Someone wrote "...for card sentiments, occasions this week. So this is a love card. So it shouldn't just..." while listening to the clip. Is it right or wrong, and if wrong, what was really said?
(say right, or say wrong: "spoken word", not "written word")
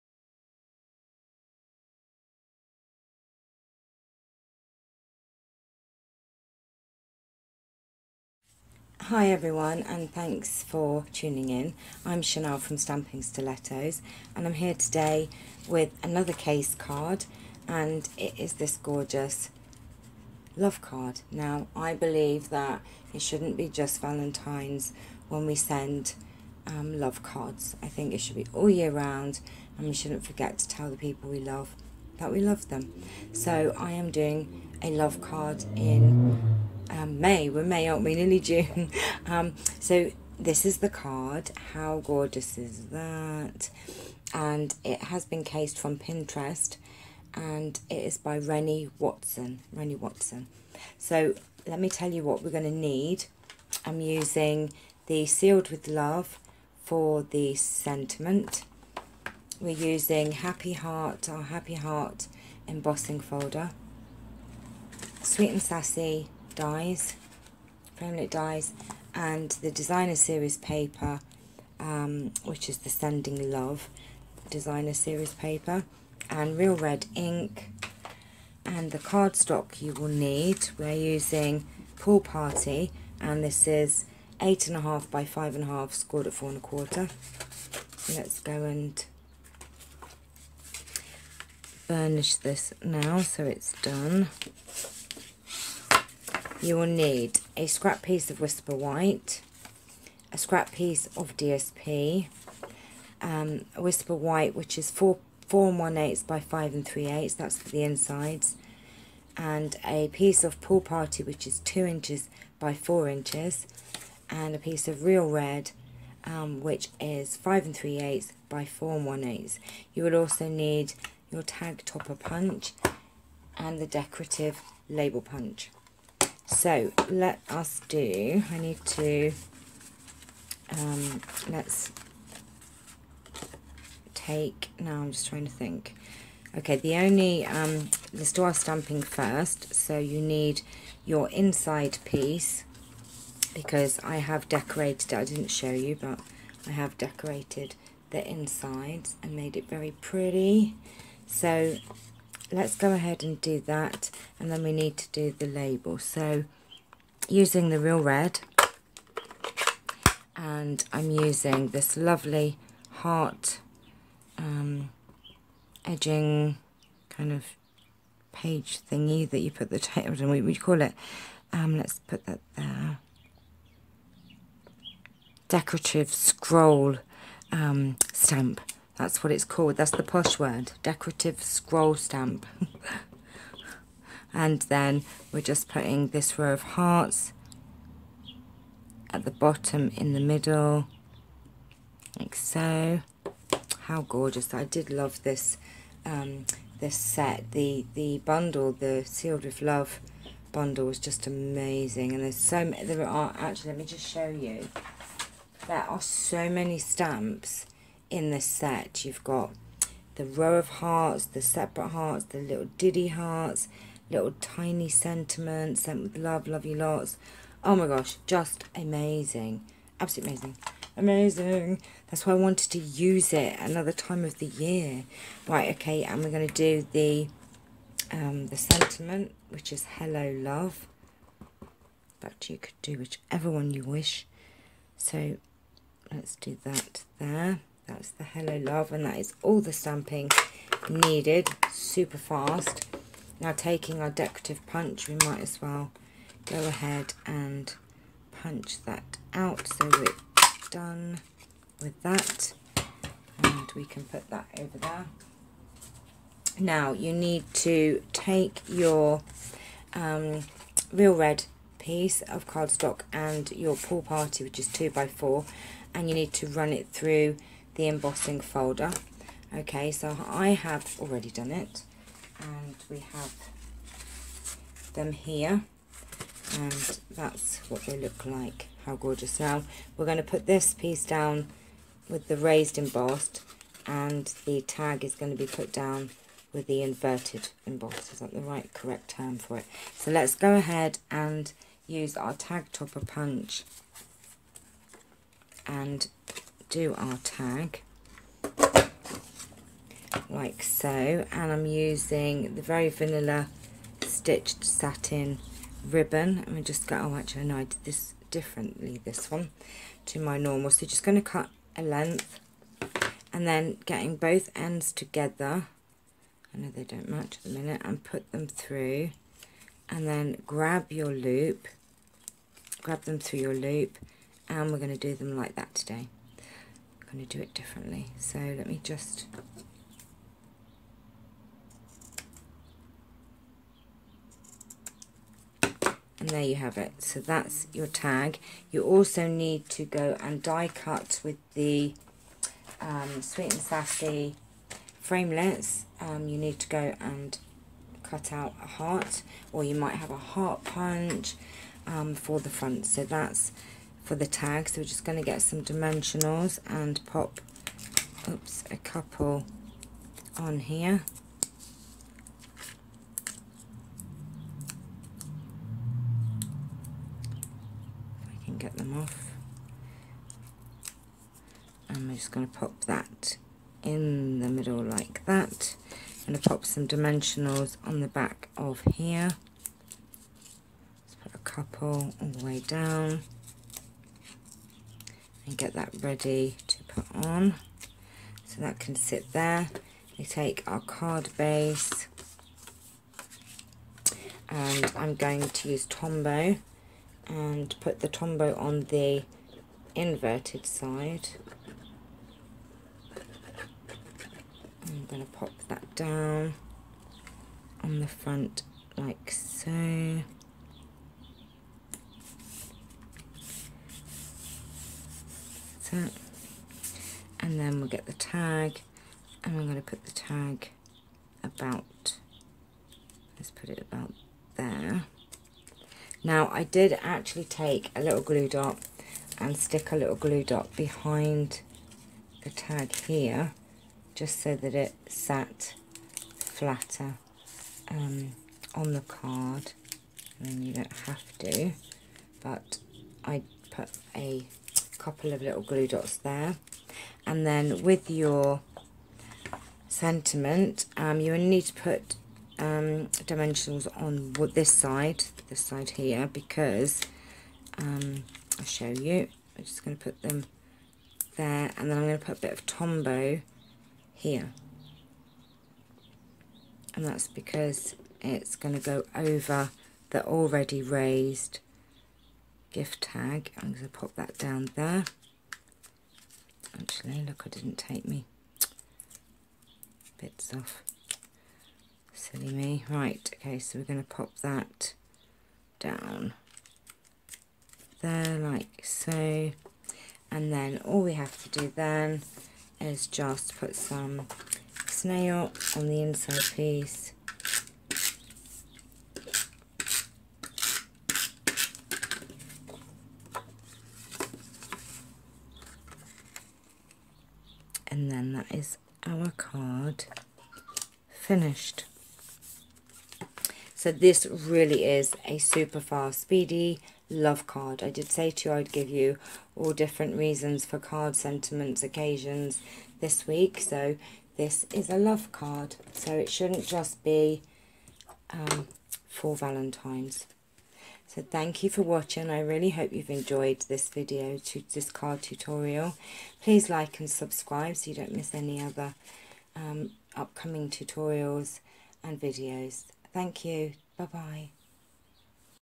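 right.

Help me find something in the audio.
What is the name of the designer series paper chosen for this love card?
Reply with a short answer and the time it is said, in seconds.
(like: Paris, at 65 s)
Sending Love, at 72 s.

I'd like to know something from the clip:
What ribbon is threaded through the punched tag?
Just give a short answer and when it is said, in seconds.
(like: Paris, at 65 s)
very vanilla stitched satin ribbon, at 302 s.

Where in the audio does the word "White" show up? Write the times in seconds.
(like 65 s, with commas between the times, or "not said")
98 s, 104 s.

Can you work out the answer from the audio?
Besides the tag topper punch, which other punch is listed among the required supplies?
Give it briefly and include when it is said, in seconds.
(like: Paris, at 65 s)
decorative label punch, at 123 s.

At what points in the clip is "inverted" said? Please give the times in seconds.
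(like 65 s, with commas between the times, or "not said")
286 s, 399 s.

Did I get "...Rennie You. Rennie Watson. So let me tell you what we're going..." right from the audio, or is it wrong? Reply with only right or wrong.
wrong.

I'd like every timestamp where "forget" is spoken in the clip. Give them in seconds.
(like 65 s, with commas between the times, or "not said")
30 s.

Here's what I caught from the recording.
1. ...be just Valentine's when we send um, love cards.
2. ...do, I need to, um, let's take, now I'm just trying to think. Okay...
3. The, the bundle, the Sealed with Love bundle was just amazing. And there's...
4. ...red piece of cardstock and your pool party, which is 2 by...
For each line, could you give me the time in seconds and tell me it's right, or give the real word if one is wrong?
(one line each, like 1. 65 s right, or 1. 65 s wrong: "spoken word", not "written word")
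1. 23 s right
2. 127 s right
3. 197 s right
4. 261 s right.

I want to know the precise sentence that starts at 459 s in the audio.
I'm just going to put them there, and then I'm going to put a bit of Tombow here.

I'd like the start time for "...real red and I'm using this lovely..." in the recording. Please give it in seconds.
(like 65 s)
157 s.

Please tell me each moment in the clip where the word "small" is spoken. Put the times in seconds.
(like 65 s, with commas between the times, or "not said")
not said.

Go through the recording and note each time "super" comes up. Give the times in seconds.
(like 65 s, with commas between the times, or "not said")
241 s, 515 s.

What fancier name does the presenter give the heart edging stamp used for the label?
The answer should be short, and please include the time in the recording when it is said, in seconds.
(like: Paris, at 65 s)
Decorative scroll stamp, at 180 s.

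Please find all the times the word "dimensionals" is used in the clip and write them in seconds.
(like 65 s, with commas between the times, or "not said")
355 s, 376 s, 453 s.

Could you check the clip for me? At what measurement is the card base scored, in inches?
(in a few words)
4 1/4.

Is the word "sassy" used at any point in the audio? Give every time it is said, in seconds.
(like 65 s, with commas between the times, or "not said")
65 s, 343 s.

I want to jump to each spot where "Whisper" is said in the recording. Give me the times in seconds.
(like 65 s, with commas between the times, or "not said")
98 s, 103 s.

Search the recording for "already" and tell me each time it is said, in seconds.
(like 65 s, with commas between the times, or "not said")
270 s, 470 s.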